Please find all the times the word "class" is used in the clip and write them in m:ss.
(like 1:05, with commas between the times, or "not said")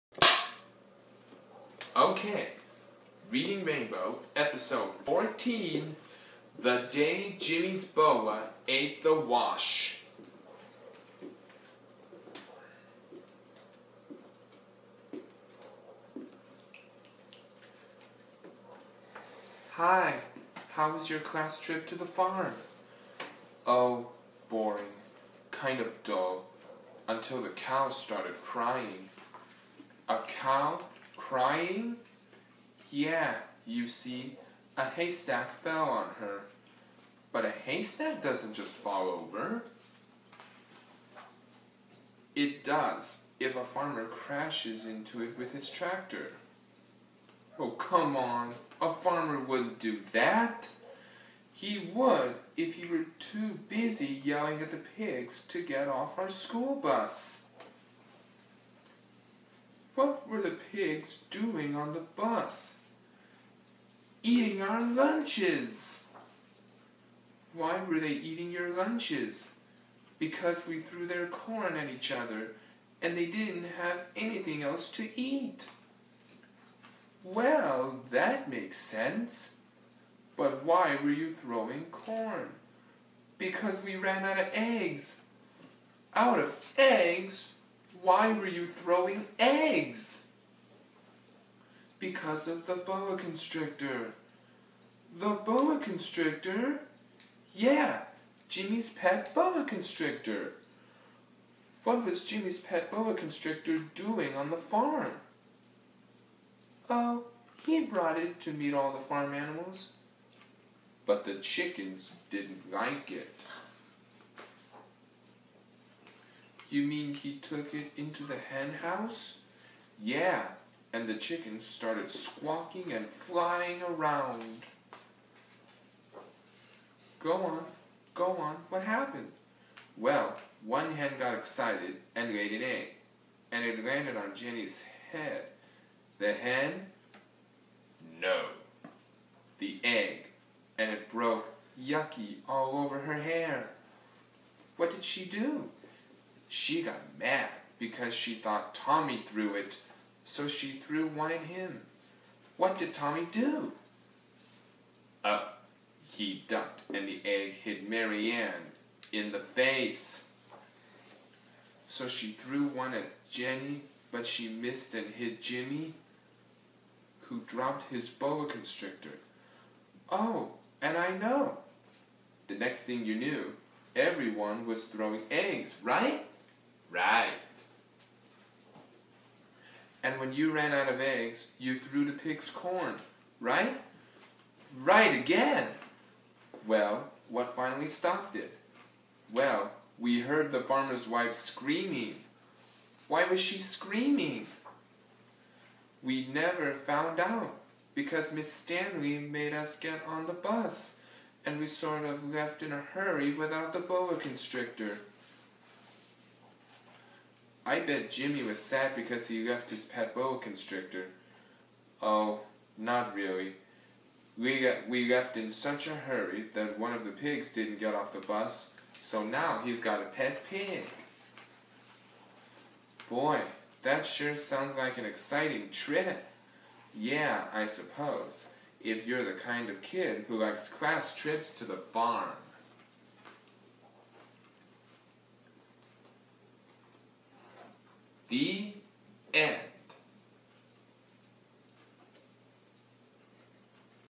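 0:21, 3:50.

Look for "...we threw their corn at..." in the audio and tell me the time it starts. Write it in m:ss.
1:10.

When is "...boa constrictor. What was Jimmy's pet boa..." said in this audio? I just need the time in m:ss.
1:39.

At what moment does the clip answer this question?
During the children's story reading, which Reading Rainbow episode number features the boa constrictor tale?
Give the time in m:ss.
0:04.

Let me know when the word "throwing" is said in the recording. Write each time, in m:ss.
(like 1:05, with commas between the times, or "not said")
1:21, 1:28, 2:54.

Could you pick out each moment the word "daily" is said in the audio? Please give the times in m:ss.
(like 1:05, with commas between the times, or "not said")
not said.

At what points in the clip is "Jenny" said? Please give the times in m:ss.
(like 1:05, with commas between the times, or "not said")
2:14, 2:43.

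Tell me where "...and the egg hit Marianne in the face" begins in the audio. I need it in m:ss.
2:36.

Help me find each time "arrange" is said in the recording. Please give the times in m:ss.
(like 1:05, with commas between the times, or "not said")
not said.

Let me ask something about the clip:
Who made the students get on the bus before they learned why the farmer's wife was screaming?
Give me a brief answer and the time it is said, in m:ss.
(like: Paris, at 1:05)
Miss Stanley, at 3:18.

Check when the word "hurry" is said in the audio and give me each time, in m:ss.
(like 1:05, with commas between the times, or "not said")
3:22, 3:35.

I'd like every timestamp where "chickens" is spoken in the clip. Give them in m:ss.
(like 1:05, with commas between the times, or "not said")
1:51, 2:01.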